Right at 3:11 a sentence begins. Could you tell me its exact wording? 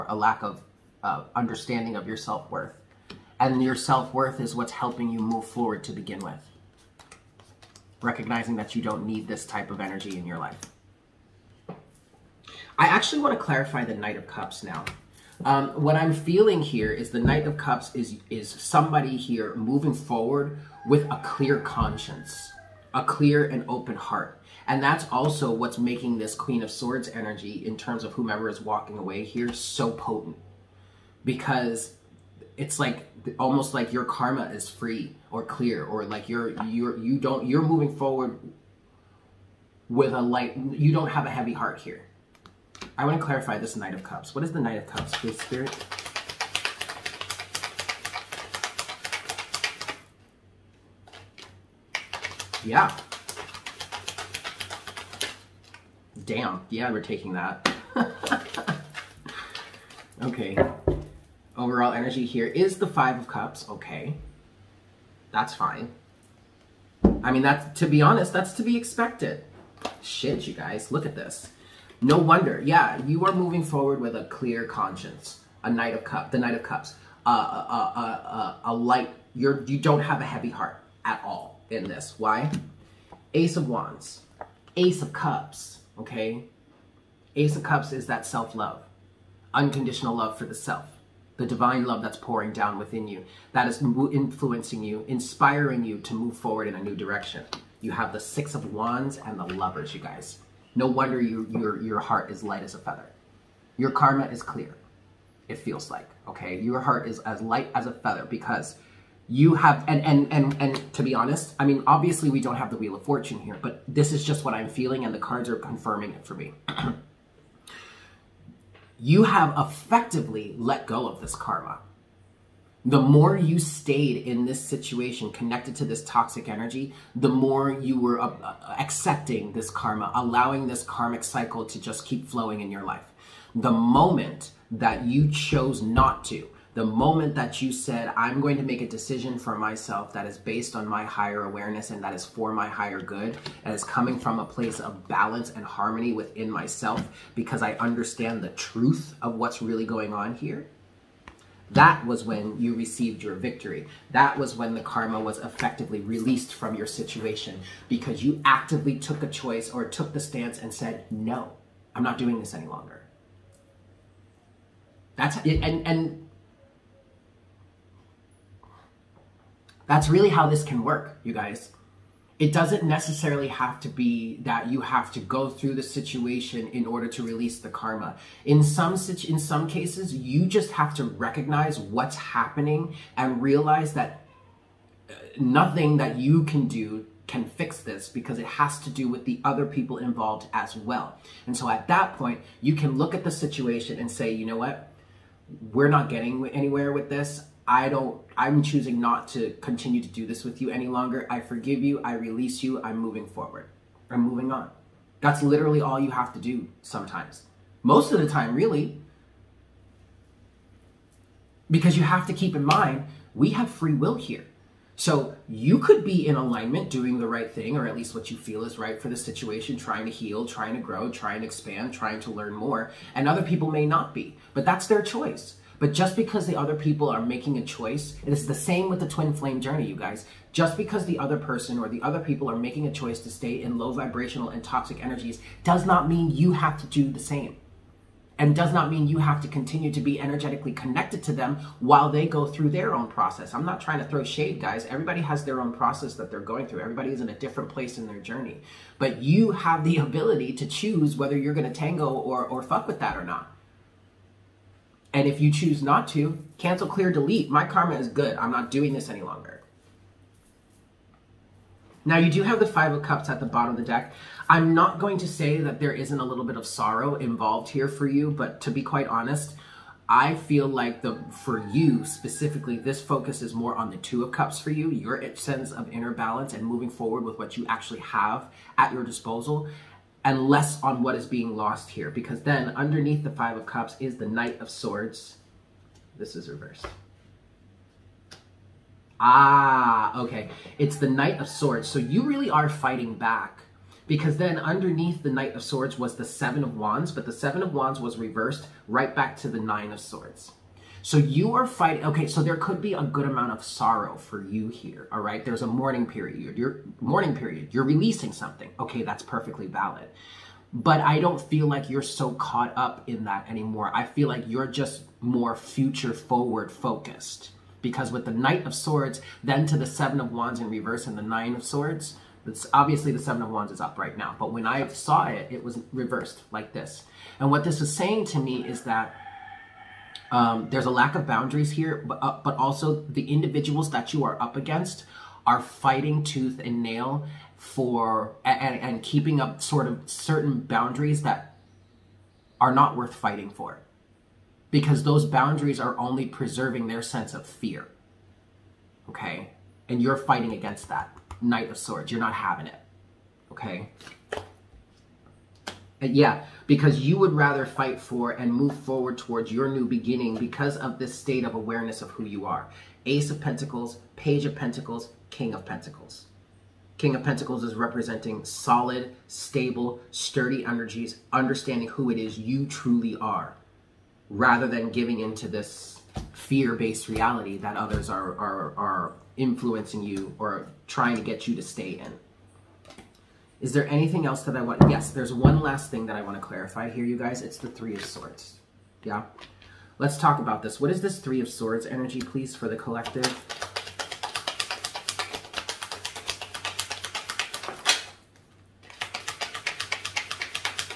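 And so at that point, you can look at the situation and say, you know what?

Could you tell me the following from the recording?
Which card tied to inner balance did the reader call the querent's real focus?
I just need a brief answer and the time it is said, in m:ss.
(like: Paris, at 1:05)
Two of Cups, at 4:33.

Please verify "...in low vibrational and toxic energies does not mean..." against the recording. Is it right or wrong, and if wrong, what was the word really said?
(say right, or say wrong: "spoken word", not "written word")
right.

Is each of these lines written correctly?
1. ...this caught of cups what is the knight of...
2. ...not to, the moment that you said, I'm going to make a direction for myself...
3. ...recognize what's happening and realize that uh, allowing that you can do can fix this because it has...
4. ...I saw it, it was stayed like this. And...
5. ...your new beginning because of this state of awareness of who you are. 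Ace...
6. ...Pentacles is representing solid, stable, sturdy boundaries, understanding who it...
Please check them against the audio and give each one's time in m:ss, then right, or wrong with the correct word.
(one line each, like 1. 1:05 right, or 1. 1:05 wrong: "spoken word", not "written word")
1. 0:43 wrong: "knight", not "caught"
2. 2:15 wrong: "decision", not "direction"
3. 3:01 wrong: "nothing", not "allowing"
4. 5:24 wrong: "reversed", not "stayed"
5. 5:59 right
6. 6:07 wrong: "energies", not "boundaries".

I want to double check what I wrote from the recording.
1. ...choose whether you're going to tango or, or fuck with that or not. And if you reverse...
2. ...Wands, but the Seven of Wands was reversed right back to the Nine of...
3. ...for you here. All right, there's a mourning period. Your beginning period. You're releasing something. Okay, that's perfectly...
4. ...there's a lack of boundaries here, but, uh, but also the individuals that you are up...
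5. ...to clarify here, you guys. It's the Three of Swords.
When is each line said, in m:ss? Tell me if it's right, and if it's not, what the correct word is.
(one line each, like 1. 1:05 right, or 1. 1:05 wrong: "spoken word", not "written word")
1. 4:10 wrong: "choose", not "reverse"
2. 4:56 right
3. 5:04 wrong: "mourning", not "beginning"
4. 5:30 right
5. 6:26 right.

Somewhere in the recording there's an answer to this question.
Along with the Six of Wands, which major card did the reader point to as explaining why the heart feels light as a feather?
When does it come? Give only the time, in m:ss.
1:39.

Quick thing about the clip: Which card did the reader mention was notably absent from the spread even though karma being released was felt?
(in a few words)
Wheel of Fortune.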